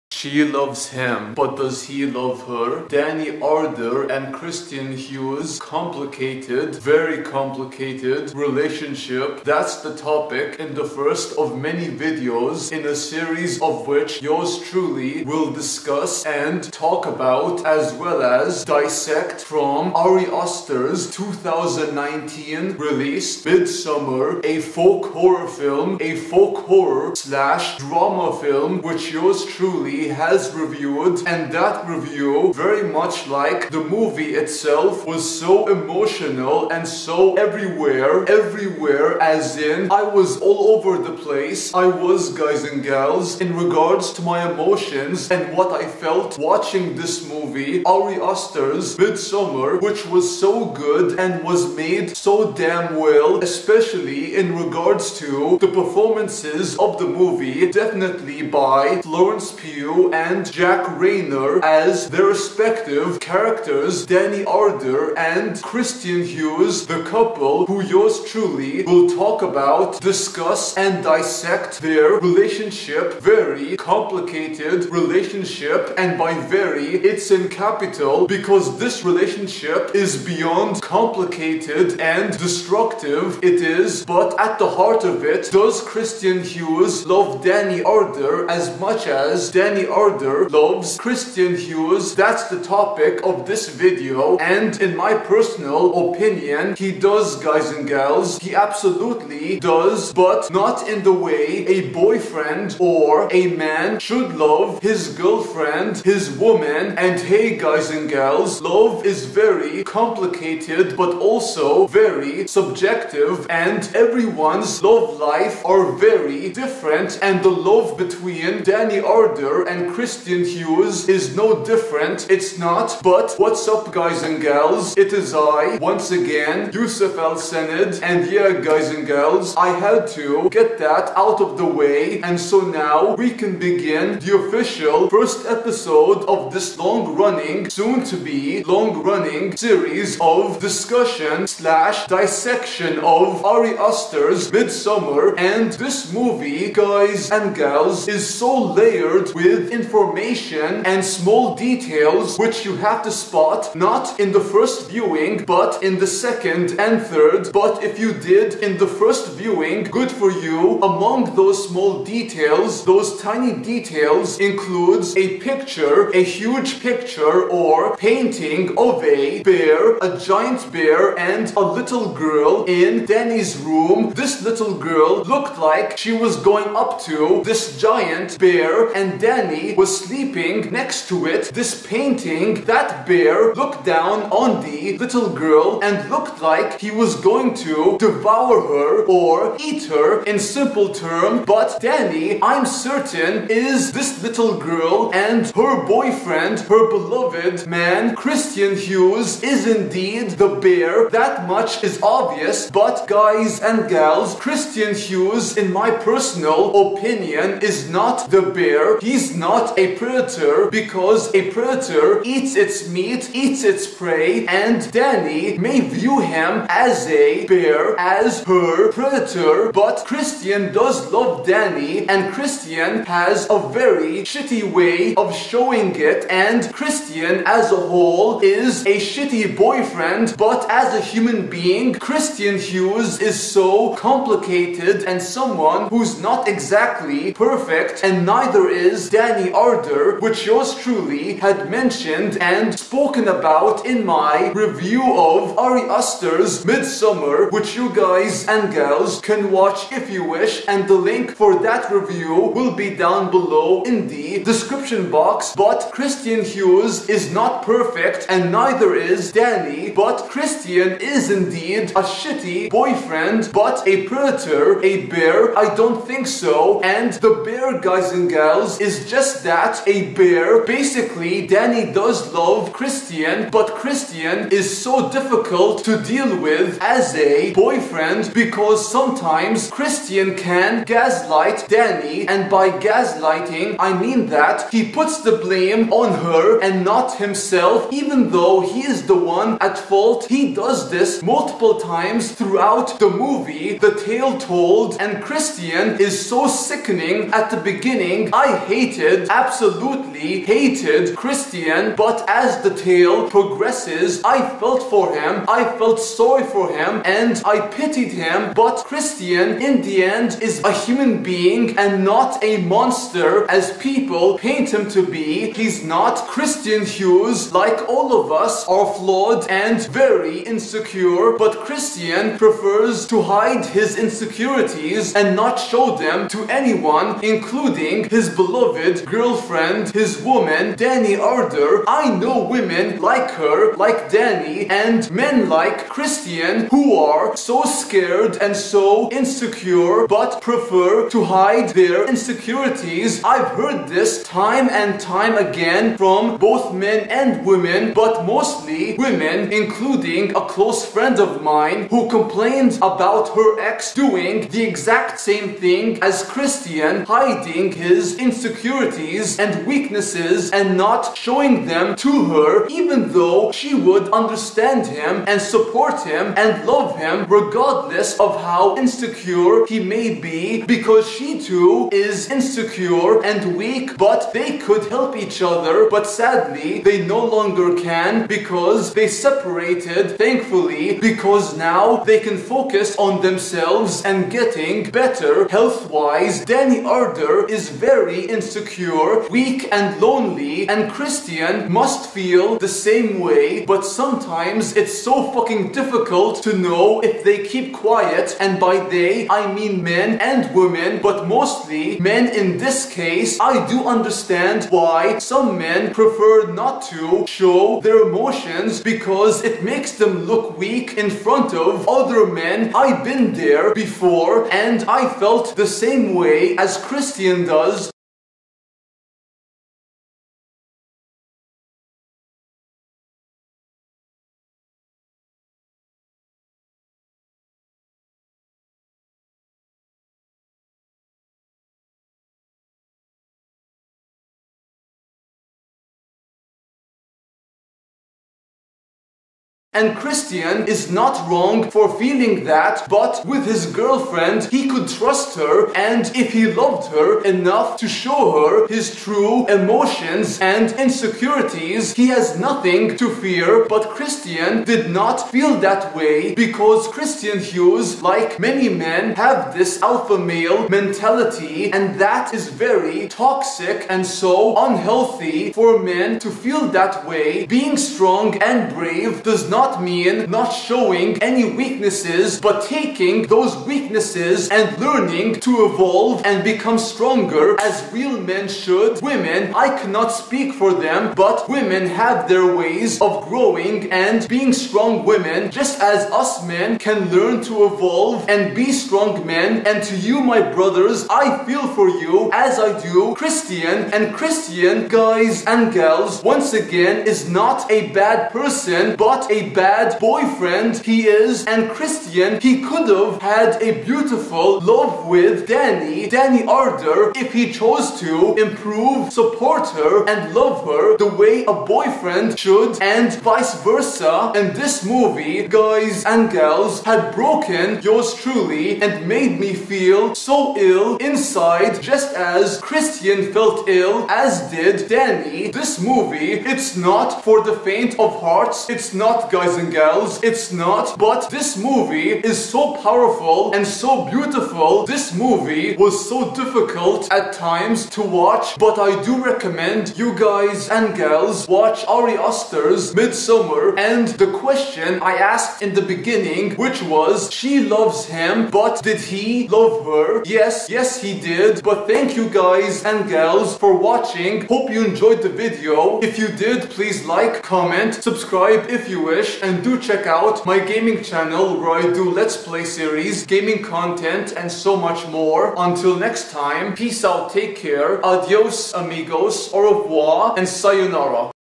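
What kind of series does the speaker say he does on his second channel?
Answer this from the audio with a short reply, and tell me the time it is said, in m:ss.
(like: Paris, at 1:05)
Let's Play series, at 9:22.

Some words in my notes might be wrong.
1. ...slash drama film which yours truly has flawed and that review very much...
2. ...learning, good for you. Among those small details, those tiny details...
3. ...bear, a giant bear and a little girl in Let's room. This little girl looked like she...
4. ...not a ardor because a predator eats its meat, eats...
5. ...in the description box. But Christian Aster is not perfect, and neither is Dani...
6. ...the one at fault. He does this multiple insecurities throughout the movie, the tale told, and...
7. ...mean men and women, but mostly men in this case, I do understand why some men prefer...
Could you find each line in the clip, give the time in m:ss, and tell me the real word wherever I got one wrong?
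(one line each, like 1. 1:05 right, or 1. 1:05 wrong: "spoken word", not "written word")
1. 0:27 wrong: "reviewed", not "flawed"
2. 2:39 wrong: "viewing", not "learning"
3. 2:49 wrong: "Dani", not "Let"
4. 3:29 wrong: "predator", not "ardor"
5. 4:13 wrong: "Hughes", not "Aster"
6. 4:49 wrong: "times", not "insecurities"
7. 6:39 right.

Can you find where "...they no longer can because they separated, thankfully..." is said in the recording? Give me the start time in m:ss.
6:16.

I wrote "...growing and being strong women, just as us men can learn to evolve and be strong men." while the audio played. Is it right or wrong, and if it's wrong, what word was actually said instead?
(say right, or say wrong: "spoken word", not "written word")
right.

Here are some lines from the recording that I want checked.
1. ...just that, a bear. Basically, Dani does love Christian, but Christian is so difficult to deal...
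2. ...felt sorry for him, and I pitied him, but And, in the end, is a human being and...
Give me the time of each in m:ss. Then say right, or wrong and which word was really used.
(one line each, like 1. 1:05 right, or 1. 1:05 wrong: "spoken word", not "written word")
1. 4:29 right
2. 5:05 wrong: "Christian", not "And".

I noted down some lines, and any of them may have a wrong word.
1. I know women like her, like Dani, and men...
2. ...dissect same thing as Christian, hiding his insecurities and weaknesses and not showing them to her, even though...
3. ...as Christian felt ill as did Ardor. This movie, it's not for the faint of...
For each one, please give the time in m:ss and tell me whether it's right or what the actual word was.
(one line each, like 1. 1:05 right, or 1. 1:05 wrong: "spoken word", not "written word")
1. 5:31 right
2. 5:54 wrong: "exact", not "dissect"
3. 8:42 wrong: "Dani", not "Ardor".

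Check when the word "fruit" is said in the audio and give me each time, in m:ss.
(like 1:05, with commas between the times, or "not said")
not said.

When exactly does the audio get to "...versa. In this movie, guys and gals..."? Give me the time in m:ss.
8:33.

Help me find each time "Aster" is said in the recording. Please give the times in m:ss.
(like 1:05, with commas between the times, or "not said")
0:20, 0:48, 2:23, 4:05, 9:02.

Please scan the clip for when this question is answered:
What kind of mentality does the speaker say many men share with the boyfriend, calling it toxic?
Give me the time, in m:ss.
7:39.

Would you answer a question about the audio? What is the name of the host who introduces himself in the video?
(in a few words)
Yusuf Al Sanad.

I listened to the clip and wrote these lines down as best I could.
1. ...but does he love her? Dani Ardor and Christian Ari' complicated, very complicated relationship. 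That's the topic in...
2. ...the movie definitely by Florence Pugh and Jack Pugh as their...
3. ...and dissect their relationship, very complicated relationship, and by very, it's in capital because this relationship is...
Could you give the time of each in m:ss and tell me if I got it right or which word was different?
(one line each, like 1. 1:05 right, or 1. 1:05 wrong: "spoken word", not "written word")
1. 0:01 wrong: "Hughes", not "Ari"
2. 0:56 wrong: "Reynor", not "Pugh"
3. 1:10 right.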